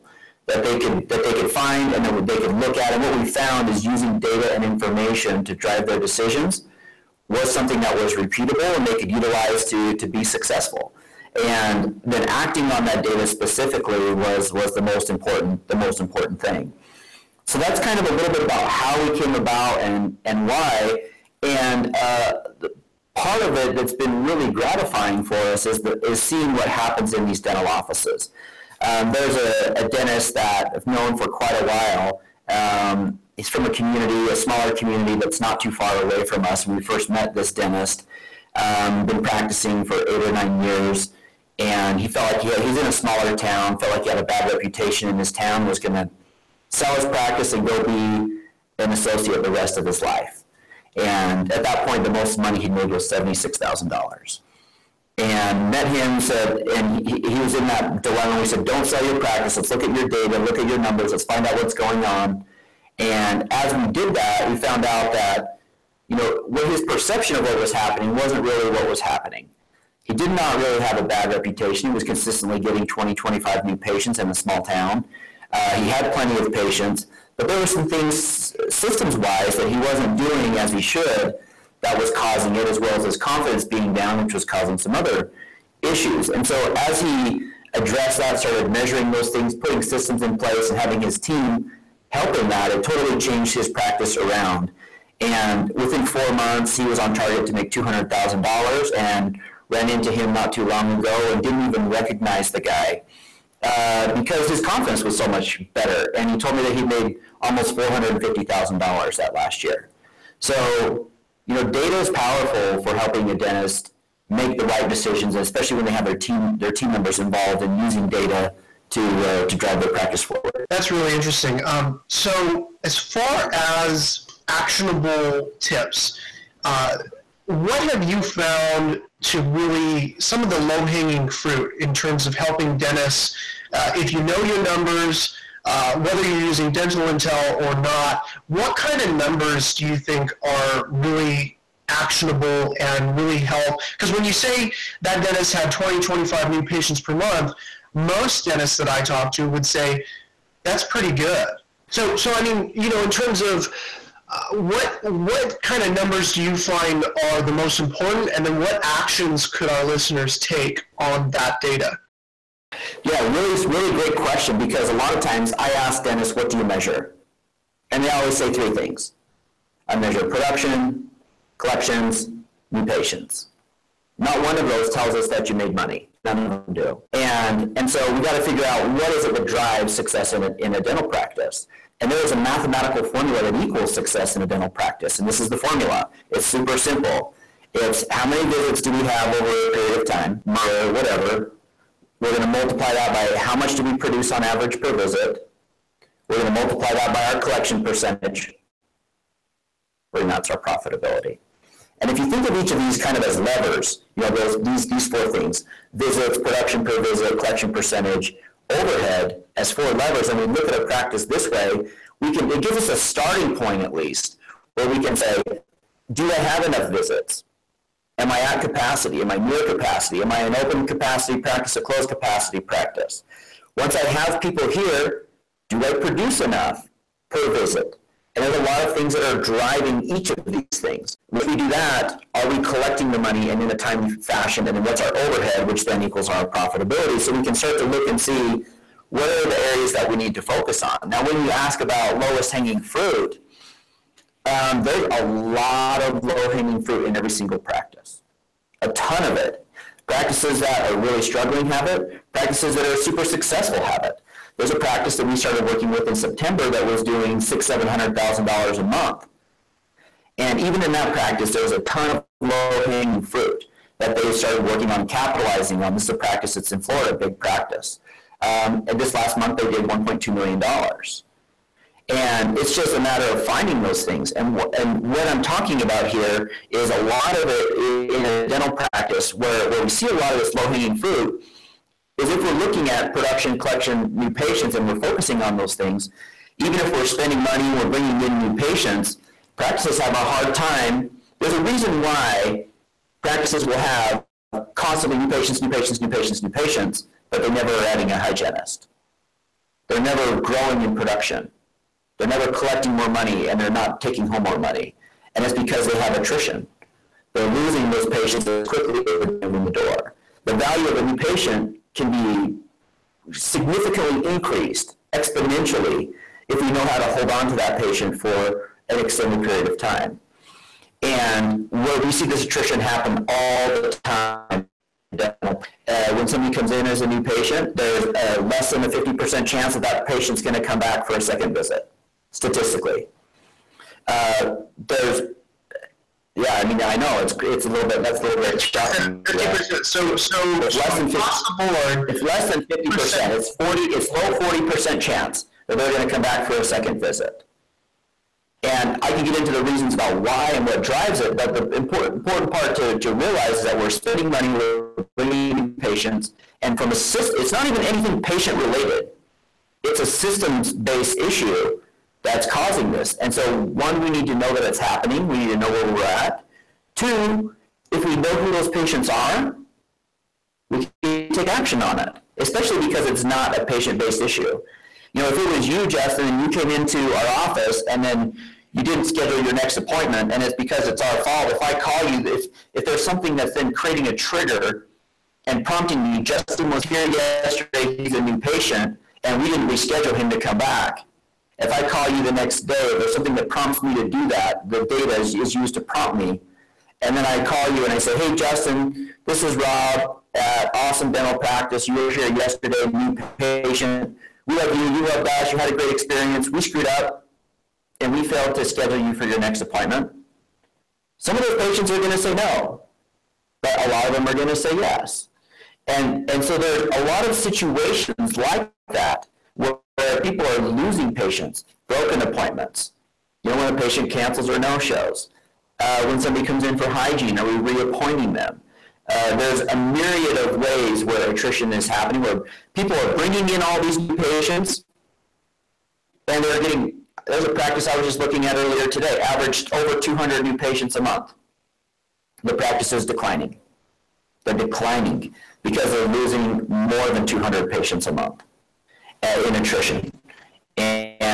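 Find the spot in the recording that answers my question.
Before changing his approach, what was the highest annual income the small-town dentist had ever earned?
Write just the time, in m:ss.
0:53.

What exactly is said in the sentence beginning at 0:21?
And uh, part of it that's been really gratifying for us is, the, is seeing what happens in these dental offices.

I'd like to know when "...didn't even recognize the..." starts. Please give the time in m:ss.
1:41.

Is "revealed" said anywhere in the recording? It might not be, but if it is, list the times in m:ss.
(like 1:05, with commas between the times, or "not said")
not said.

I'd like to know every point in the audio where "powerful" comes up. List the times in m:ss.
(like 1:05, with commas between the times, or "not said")
1:52.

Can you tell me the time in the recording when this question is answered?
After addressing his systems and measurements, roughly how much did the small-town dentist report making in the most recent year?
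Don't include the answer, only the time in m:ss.
1:47.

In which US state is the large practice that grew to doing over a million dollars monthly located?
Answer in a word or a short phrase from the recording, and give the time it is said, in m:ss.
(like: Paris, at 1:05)
Florida, at 4:26.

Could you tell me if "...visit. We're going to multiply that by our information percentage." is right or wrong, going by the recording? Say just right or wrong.
wrong.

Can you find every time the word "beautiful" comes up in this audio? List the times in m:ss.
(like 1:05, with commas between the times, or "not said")
not said.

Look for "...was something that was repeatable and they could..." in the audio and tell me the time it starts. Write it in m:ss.
0:07.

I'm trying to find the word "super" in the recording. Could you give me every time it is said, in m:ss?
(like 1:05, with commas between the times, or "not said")
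3:06, 4:12.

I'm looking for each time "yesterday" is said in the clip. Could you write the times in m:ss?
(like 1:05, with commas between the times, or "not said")
6:27, 6:42.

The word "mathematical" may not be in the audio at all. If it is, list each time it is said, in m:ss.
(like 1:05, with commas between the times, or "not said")
3:02.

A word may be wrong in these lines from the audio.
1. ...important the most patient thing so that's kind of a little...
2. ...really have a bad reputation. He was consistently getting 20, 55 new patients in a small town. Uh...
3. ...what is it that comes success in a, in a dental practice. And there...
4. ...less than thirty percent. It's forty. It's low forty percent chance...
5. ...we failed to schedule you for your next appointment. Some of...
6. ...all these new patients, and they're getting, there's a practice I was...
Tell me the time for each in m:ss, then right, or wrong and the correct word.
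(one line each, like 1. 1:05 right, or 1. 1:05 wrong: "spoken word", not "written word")
1. 0:15 wrong: "important", not "patient"
2. 1:10 wrong: "25", not "55"
3. 2:58 wrong: "drives", not "comes"
4. 5:42 wrong: "fifty", not "thirty"
5. 6:48 right
6. 7:13 right.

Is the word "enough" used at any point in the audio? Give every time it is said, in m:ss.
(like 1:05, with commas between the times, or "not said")
3:36, 3:46.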